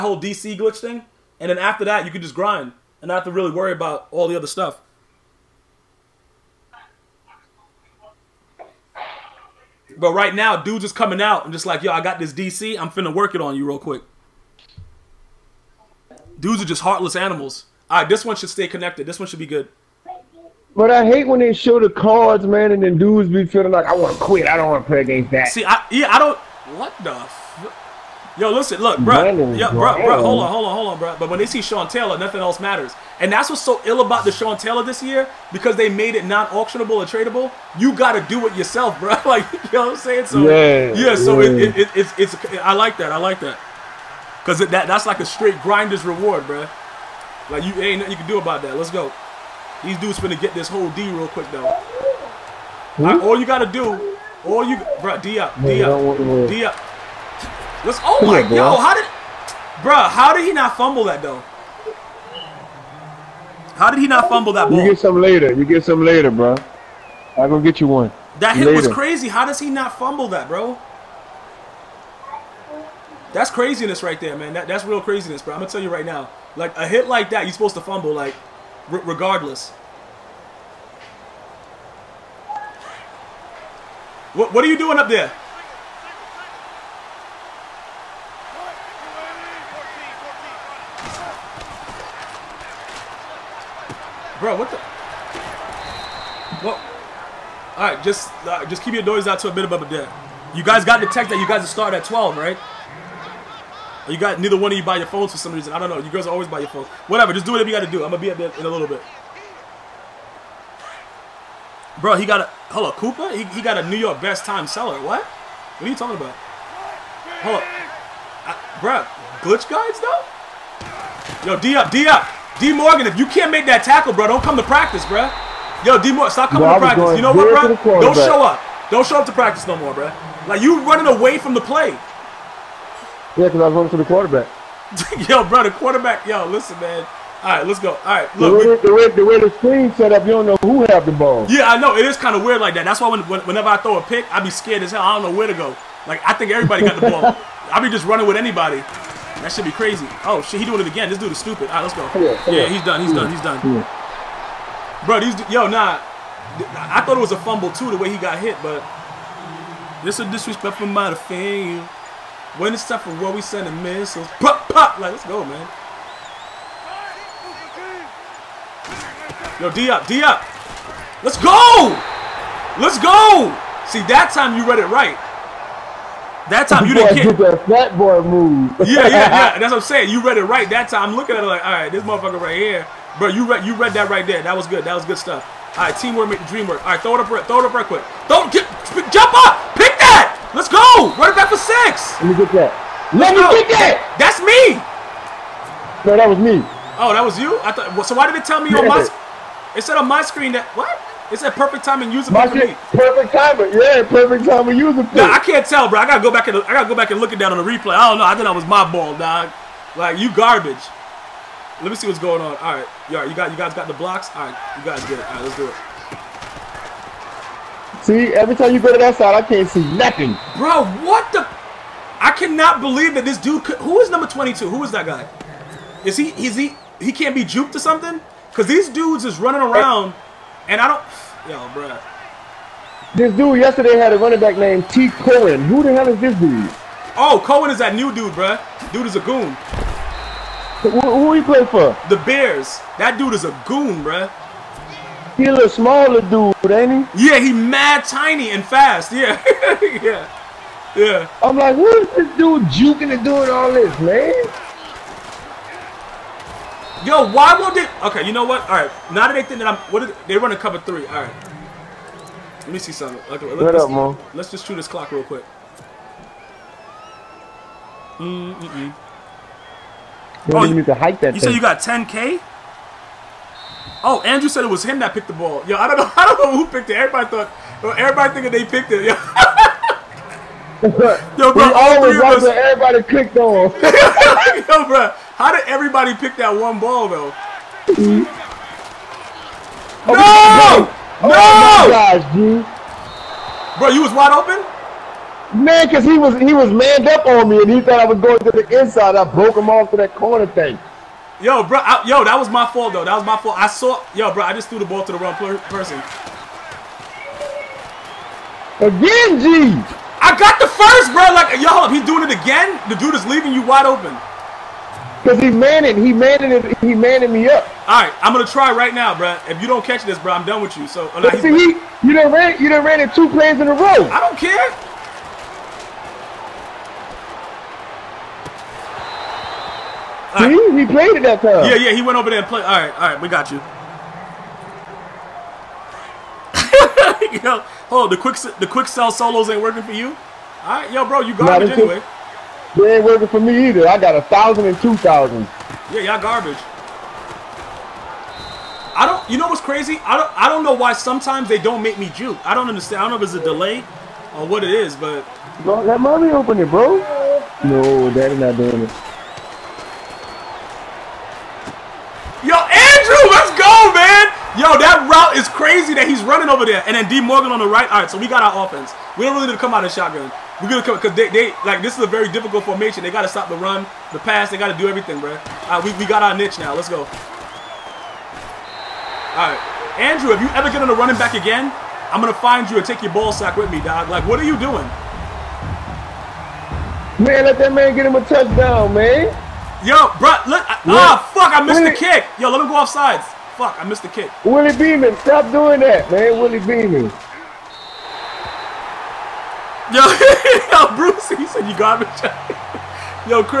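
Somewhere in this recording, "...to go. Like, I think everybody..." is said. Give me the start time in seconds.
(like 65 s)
145 s.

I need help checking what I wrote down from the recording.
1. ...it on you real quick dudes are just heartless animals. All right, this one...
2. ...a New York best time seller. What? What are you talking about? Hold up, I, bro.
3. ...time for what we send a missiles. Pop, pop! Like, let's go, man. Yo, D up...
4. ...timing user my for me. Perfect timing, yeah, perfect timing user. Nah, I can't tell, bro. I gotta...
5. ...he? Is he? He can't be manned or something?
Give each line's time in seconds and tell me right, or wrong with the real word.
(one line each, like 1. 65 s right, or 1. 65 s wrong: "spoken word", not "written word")
1. 13 s right
2. 113 s right
3. 162 s right
4. 201 s right
5. 226 s wrong: "juked", not "manned".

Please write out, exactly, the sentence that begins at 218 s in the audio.
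See, every time you go to that side, I can't see nothing.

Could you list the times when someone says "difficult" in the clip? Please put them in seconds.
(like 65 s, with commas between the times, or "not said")
372 s.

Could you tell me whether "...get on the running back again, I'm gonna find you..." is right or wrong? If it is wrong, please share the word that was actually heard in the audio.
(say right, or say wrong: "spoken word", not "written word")
right.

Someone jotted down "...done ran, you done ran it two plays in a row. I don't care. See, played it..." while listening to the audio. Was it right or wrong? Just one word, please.
right.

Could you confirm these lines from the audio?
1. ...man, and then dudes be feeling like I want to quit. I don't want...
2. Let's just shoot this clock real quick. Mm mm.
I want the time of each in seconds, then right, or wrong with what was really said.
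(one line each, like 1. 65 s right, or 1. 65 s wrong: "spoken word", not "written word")
1. 22 s right
2. 264 s right.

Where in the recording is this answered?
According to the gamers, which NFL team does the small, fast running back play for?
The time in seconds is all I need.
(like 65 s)
242 s.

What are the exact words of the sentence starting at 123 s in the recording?
If you can't make that tackle, bro, don't come to practice, bro.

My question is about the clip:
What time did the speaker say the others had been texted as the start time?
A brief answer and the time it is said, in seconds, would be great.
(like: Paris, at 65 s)
12, at 102 s.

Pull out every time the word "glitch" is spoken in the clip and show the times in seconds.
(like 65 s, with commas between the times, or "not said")
0 s, 119 s.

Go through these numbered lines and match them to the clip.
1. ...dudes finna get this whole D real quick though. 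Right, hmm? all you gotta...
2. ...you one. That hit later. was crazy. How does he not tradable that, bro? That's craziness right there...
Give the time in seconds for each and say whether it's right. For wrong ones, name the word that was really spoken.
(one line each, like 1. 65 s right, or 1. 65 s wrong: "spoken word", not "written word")
1. 49 s right
2. 67 s wrong: "fumble", not "tradable".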